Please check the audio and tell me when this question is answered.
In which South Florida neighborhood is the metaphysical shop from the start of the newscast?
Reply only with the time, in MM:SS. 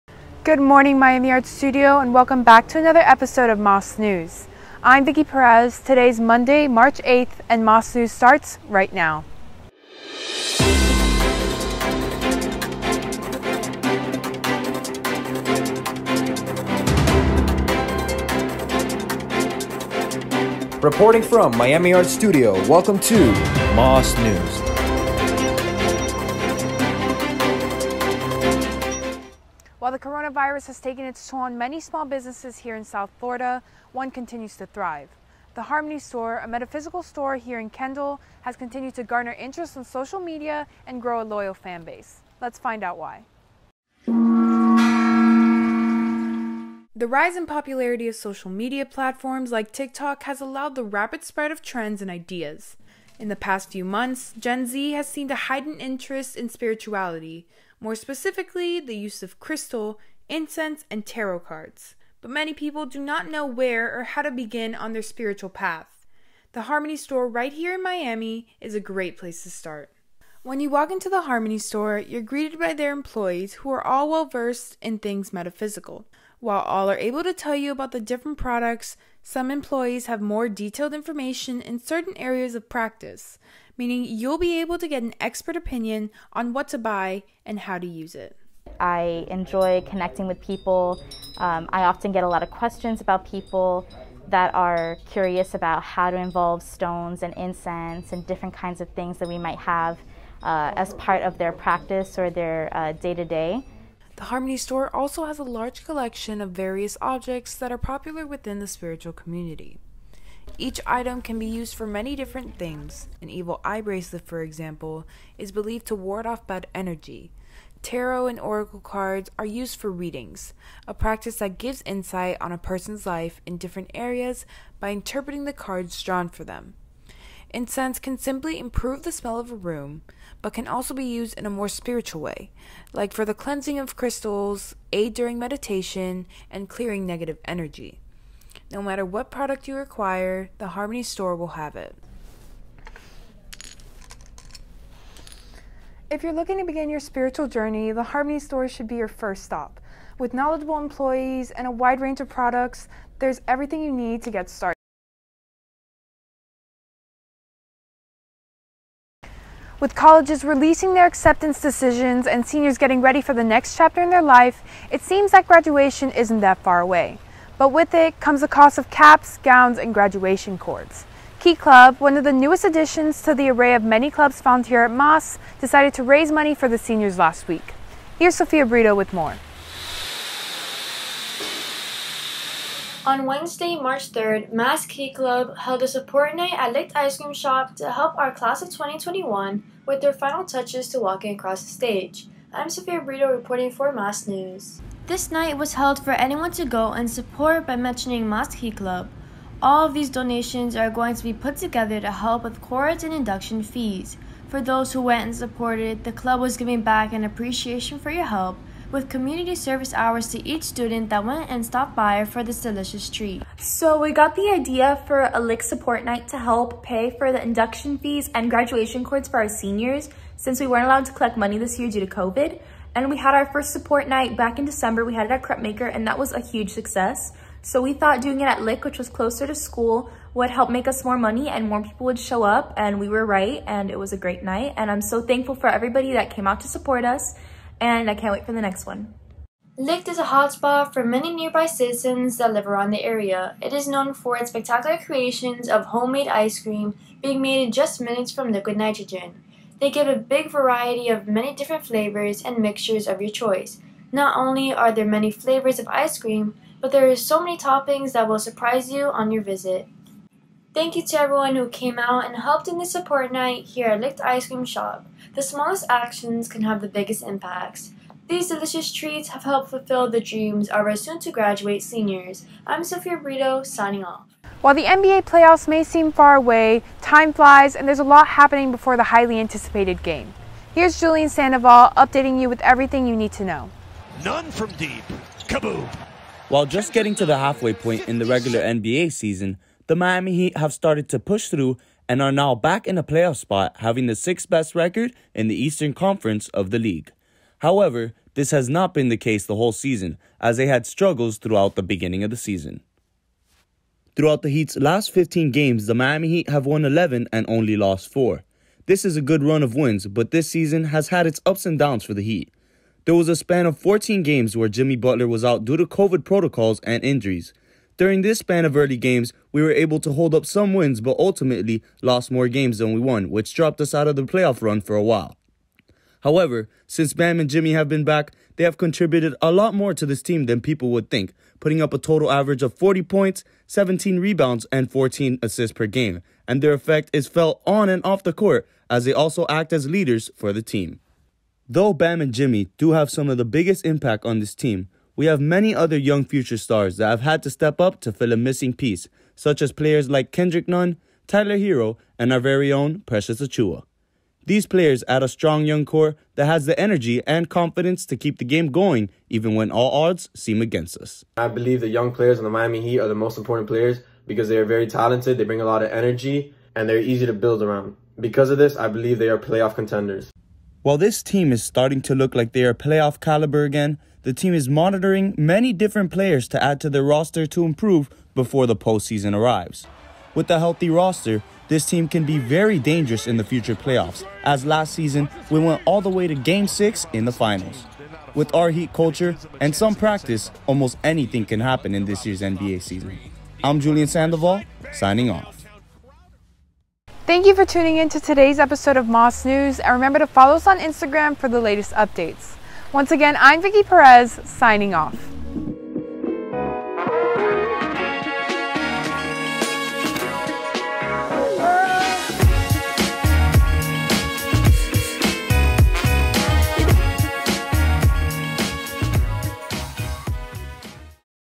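00:37.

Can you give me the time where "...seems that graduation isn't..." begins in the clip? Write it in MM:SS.
02:45.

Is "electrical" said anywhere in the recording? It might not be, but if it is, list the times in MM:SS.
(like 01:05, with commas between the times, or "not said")
not said.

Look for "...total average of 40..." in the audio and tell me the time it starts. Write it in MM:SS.
05:31.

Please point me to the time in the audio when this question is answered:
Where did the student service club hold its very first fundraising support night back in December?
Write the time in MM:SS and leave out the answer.
03:45.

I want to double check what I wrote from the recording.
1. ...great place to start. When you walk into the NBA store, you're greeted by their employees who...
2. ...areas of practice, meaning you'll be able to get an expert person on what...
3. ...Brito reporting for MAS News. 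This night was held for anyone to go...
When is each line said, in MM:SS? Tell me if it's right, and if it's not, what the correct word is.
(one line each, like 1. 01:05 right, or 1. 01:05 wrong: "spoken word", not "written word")
1. 01:08 wrong: "Harmony", not "NBA"
2. 01:22 wrong: "opinion", not "person"
3. 03:13 right.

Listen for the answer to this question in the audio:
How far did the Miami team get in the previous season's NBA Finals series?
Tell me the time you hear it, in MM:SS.
06:26.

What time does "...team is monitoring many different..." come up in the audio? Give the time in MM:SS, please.
06:14.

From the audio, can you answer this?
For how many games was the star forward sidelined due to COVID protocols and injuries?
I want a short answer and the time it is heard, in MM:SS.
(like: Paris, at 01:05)
14, at 05:13.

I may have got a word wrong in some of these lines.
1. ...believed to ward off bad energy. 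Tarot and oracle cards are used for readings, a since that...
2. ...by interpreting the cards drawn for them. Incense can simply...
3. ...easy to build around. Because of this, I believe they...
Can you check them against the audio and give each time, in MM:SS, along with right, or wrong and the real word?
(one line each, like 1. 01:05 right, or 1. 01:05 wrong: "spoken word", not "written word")
1. 01:55 wrong: "practice", not "since"
2. 02:04 right
3. 06:06 right.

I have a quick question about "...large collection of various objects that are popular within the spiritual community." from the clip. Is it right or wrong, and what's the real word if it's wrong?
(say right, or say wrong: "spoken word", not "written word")
right.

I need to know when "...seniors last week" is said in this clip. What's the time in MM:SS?
02:56.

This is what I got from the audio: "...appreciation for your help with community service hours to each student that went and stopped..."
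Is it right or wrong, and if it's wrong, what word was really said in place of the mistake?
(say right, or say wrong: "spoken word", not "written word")
right.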